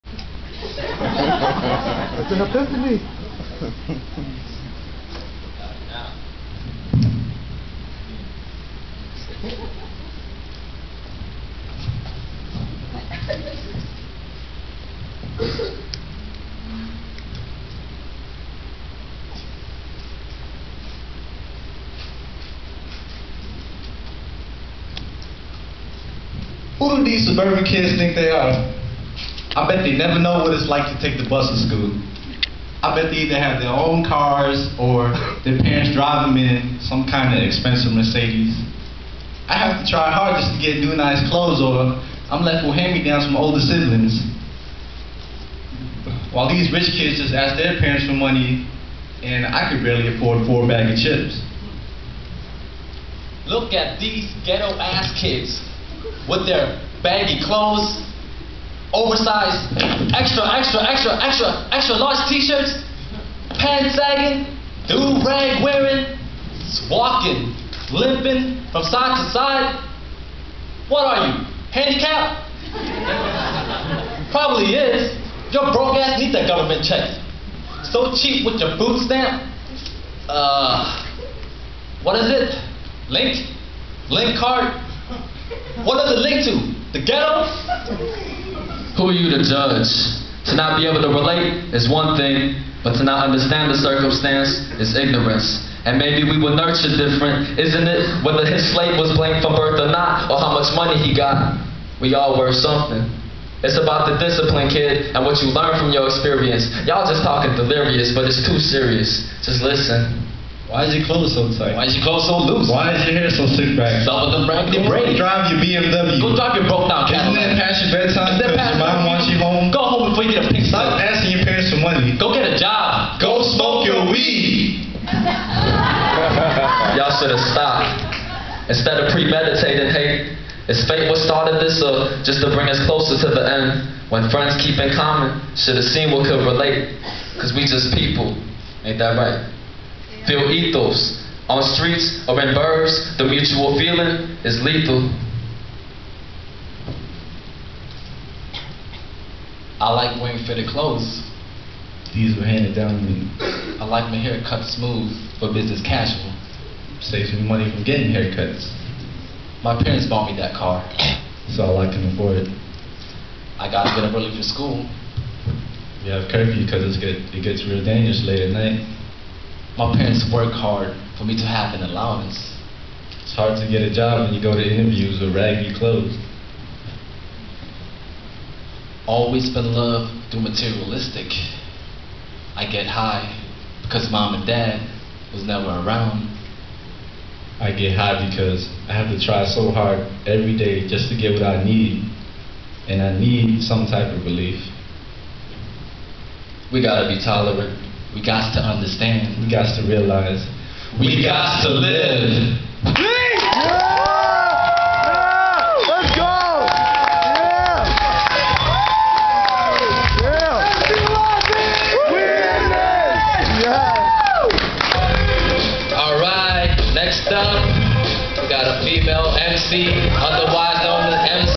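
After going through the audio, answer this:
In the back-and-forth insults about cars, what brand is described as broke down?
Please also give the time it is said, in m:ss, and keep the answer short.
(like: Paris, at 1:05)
Cadillac, at 1:57.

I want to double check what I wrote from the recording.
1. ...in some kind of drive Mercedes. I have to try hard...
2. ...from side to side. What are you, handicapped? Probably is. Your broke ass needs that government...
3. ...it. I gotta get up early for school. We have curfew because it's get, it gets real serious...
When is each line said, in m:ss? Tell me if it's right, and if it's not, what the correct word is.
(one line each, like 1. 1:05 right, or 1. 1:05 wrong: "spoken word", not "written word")
1. 0:36 wrong: "expensive", not "drive"
2. 1:08 right
3. 2:42 wrong: "dangerous", not "serious".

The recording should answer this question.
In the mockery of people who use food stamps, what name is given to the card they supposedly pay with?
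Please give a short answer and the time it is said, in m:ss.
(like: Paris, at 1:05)
Link card, at 1:24.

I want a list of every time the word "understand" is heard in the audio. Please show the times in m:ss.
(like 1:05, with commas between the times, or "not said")
1:33, 3:18.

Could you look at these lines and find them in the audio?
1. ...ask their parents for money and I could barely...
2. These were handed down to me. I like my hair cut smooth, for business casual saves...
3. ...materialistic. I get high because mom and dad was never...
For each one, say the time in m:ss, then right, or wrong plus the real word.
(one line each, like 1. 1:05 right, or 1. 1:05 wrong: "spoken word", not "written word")
1. 0:47 right
2. 2:32 right
3. 3:00 right.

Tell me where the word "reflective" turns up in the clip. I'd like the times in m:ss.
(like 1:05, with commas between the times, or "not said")
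not said.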